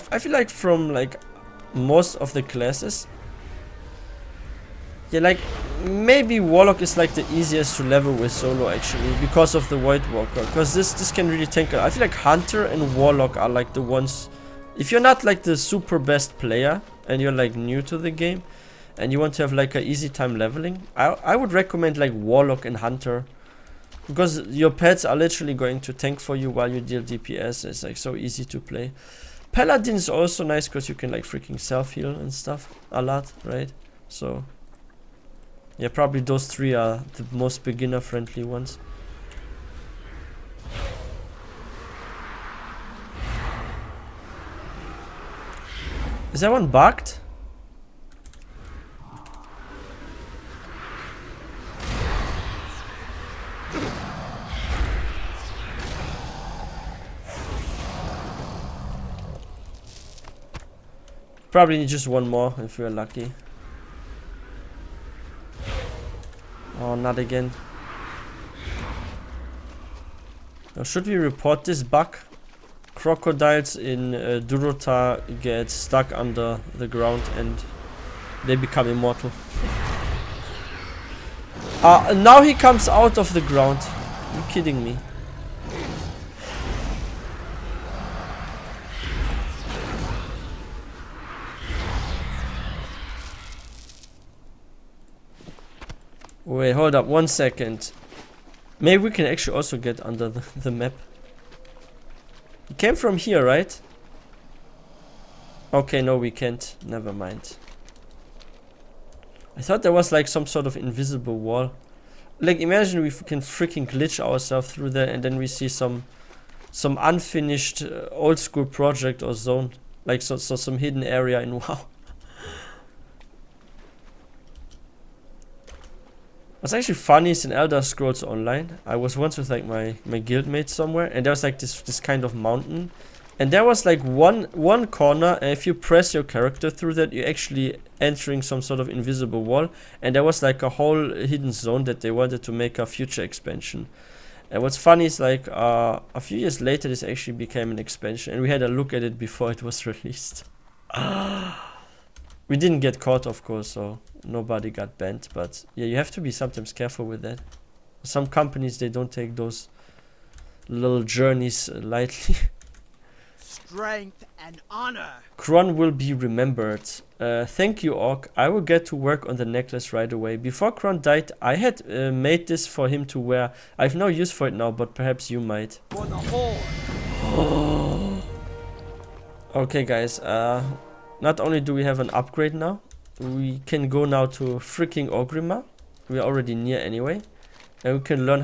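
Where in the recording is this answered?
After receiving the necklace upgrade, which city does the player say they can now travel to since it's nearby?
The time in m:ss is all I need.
3:05.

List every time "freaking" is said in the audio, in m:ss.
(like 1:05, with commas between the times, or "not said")
0:31, 1:53, 3:04.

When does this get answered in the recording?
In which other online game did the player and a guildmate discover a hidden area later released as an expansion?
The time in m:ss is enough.
2:07.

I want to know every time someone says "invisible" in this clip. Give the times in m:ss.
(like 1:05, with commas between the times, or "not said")
1:50, 2:18.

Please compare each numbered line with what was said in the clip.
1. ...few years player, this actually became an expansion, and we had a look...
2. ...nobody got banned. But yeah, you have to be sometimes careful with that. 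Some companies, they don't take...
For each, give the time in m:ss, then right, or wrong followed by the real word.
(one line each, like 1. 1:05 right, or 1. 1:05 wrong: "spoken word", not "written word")
1. 2:26 wrong: "later", not "player"
2. 2:34 right.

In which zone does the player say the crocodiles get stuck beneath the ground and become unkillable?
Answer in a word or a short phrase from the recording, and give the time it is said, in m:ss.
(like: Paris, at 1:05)
Durotar, at 1:14.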